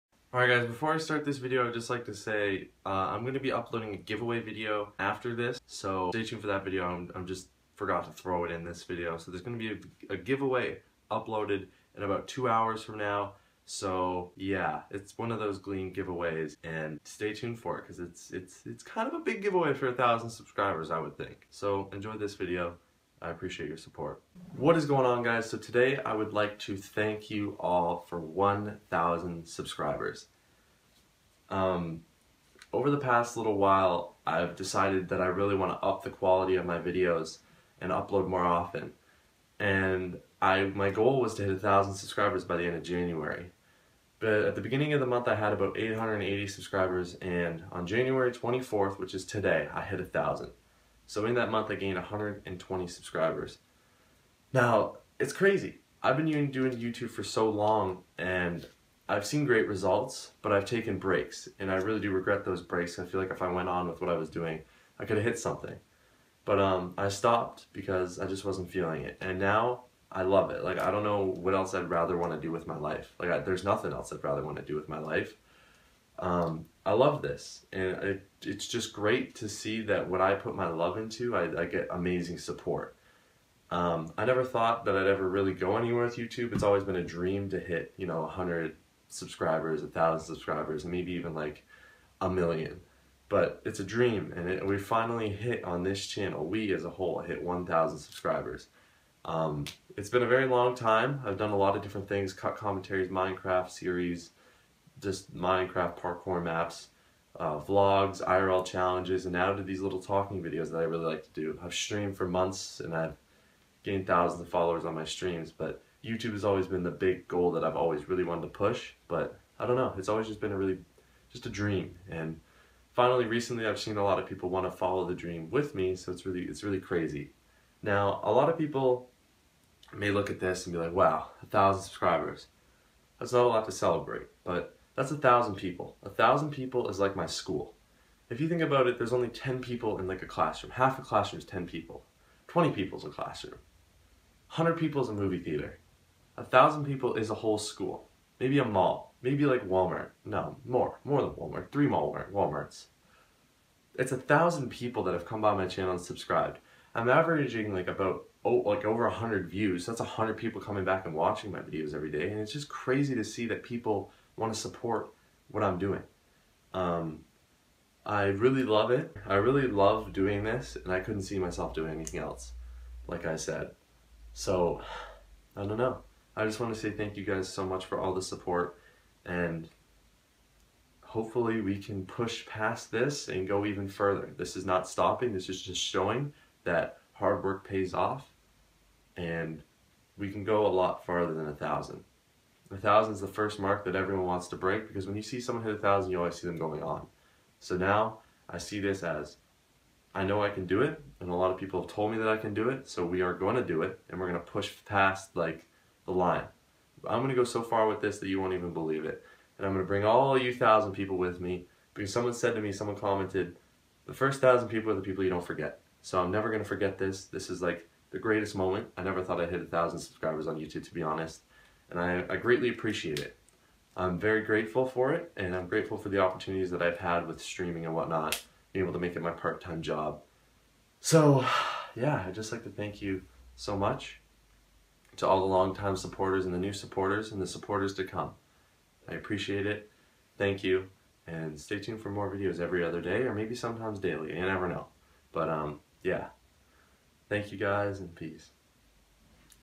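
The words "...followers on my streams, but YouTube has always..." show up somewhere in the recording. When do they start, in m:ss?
1:54.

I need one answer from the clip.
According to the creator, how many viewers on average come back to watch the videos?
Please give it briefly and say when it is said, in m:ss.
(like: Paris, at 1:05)
Over 100, at 2:38.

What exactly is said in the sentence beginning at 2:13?
That's not a lot to celebrate, but that's a thousand people.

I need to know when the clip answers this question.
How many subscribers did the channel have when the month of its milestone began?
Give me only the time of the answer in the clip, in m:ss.
0:45.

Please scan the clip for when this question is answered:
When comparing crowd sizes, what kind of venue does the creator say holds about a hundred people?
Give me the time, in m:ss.
2:25.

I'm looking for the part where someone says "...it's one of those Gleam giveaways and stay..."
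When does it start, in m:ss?
0:14.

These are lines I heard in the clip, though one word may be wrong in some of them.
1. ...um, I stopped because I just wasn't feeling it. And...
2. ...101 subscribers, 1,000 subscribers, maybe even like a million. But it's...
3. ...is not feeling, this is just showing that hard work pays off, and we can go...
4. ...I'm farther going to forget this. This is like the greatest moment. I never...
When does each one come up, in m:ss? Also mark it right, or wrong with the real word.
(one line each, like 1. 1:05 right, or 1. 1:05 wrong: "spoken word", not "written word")
1. 1:06 right
2. 1:28 wrong: "100", not "101"
3. 3:04 wrong: "stopping", not "feeling"
4. 3:36 wrong: "never", not "farther".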